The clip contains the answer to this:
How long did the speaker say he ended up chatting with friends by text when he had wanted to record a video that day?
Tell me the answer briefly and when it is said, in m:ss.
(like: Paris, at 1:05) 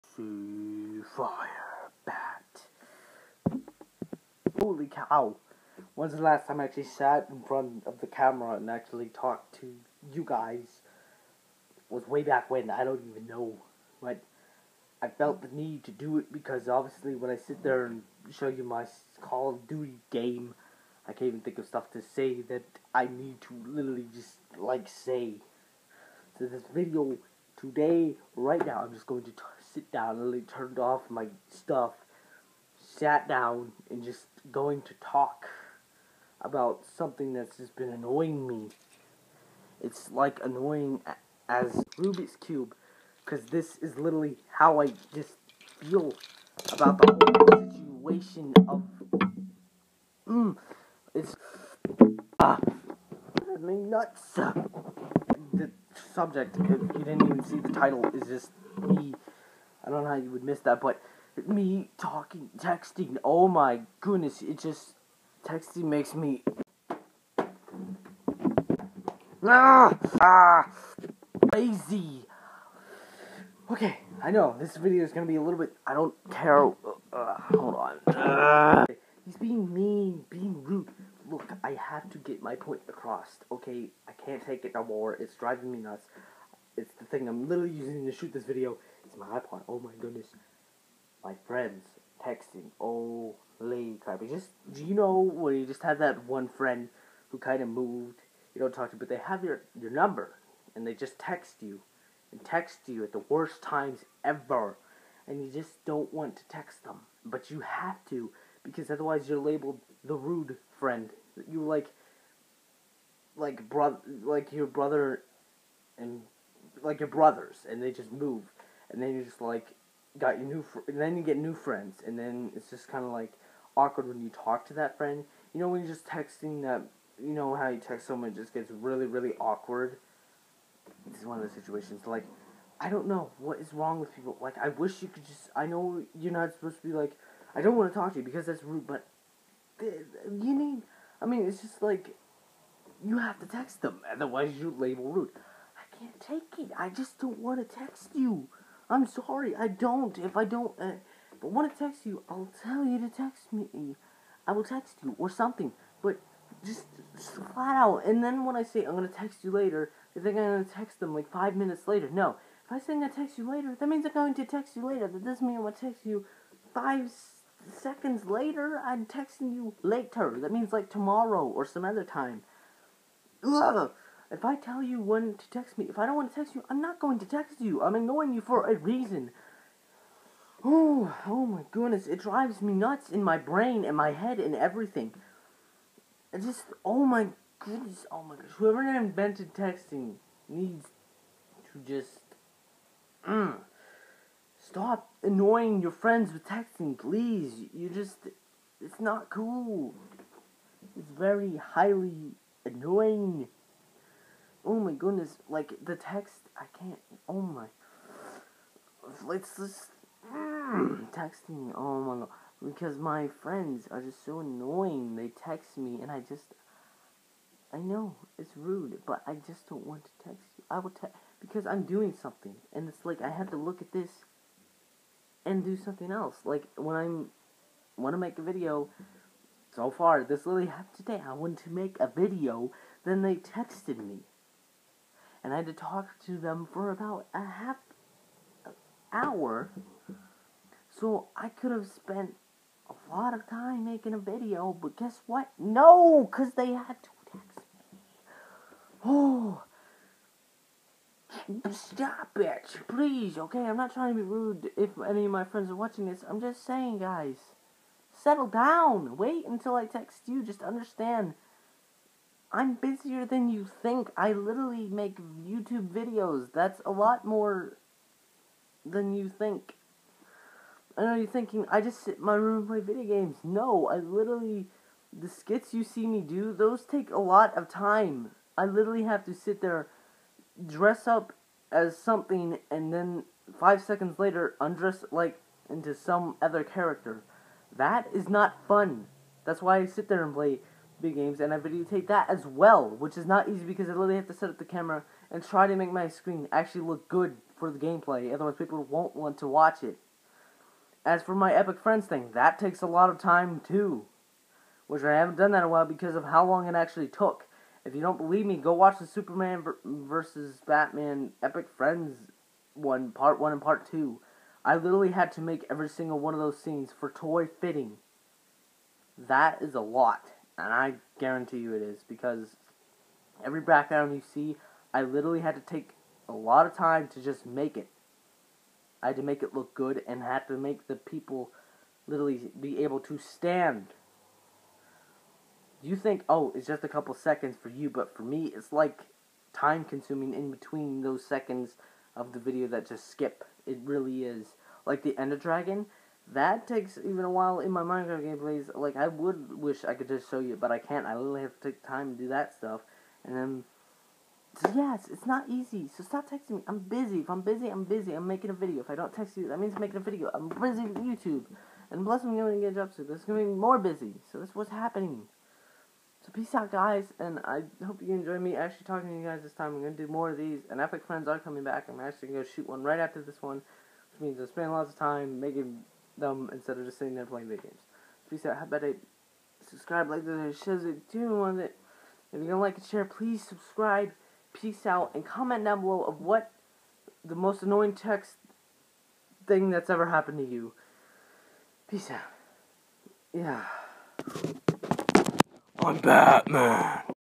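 half hour, at 3:57.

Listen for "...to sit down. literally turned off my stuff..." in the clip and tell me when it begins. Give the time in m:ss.
0:29.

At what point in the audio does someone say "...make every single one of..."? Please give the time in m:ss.
5:15.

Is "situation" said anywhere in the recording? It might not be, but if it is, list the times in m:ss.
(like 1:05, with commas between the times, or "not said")
0:47, 2:11.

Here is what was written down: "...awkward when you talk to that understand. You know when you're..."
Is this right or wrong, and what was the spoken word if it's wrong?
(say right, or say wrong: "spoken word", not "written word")
wrong: "friend", not "understand".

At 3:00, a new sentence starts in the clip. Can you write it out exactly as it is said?
Oh, oh my goodness, it drives me nuts in my brain and my head and everything.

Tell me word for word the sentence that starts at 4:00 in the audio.
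So I could have spent a lot of time making a video, but guess what?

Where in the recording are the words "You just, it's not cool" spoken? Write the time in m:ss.
3:17.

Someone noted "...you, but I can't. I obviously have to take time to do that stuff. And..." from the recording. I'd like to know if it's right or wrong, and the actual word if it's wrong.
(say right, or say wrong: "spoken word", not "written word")
wrong: "literally", not "obviously".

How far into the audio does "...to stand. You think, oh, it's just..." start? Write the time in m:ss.
5:33.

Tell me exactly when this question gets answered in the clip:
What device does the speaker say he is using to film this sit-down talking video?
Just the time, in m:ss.
1:29.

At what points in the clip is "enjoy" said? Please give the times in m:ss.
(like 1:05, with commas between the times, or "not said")
6:08.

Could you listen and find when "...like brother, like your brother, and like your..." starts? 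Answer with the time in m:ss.
1:53.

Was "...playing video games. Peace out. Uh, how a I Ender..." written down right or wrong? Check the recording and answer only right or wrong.
wrong.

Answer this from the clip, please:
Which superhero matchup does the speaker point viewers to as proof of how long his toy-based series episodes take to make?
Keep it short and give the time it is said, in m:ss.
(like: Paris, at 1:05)
Superman versus Batman, at 5:09.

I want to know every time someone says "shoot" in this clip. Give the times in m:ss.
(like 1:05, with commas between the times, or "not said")
1:28, 6:12.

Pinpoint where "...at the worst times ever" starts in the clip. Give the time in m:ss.
1:43.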